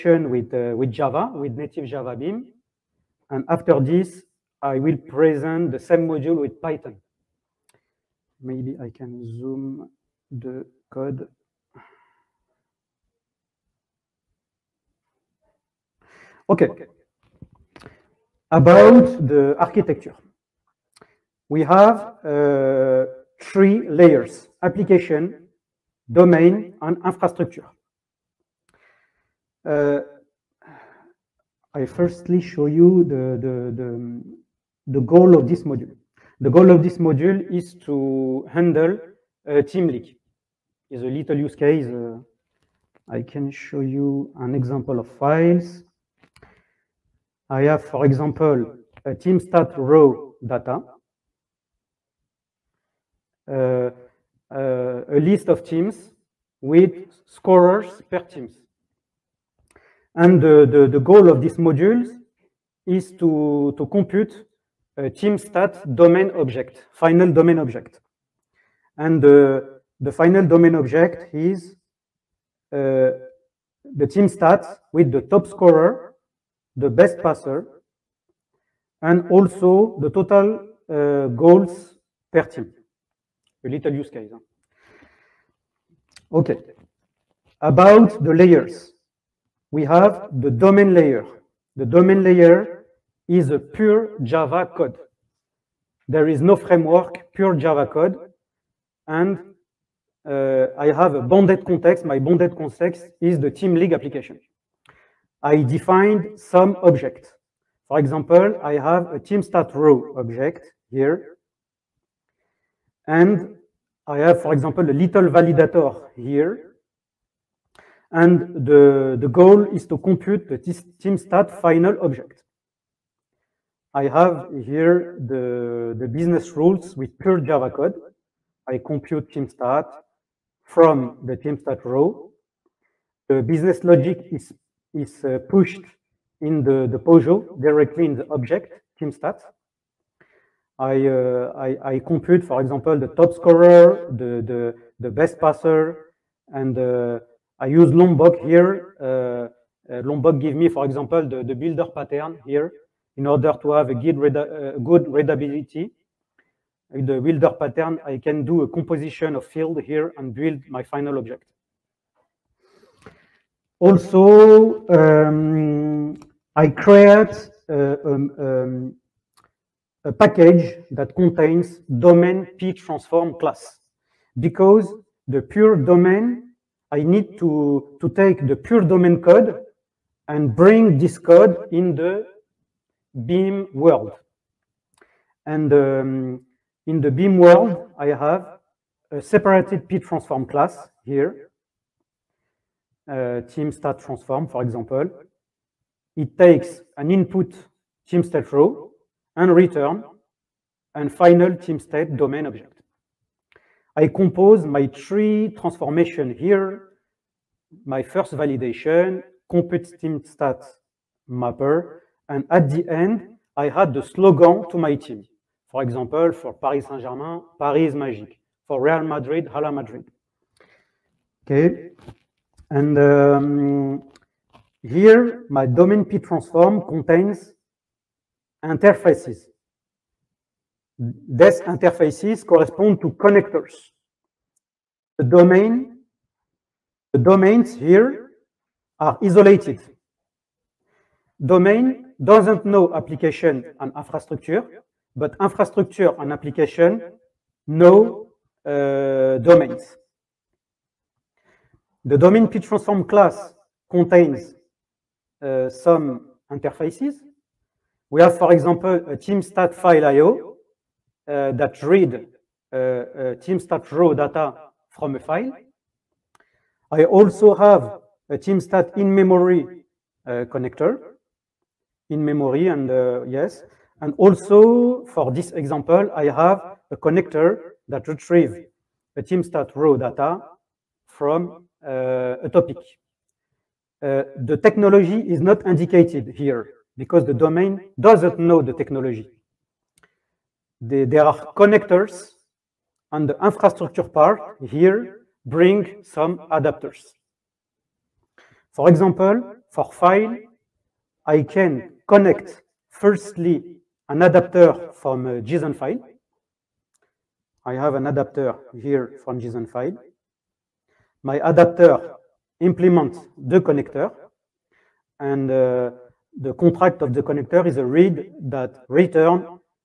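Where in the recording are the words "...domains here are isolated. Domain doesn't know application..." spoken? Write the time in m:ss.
3:57.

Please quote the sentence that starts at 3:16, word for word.
It takes an input team state row and return and final team state domain object.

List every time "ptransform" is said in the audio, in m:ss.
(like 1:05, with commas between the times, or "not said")
4:12.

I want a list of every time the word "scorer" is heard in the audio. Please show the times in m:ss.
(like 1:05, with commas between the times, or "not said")
0:57, 1:15, 2:23.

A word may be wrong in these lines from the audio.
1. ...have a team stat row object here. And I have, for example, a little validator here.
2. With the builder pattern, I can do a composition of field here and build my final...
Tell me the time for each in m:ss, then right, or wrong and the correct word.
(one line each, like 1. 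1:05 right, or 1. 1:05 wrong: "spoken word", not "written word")
1. 1:48 right
2. 2:36 right.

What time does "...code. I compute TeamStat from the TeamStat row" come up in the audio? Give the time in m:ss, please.
2:07.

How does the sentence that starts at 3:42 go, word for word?
And um, here, my domain P transform contains interfaces.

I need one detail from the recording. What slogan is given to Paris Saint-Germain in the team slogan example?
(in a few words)
Paris Magic.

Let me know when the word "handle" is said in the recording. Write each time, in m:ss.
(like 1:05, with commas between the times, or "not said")
0:38.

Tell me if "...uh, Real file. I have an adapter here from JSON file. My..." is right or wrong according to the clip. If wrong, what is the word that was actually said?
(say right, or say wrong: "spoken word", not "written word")
wrong: "JSON", not "Real".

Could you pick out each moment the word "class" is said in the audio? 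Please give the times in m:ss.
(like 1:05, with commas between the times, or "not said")
2:53, 3:10, 4:13.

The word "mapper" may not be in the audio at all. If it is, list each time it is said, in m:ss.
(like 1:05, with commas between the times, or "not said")
3:31.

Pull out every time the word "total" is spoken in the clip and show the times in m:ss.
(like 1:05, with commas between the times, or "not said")
1:20.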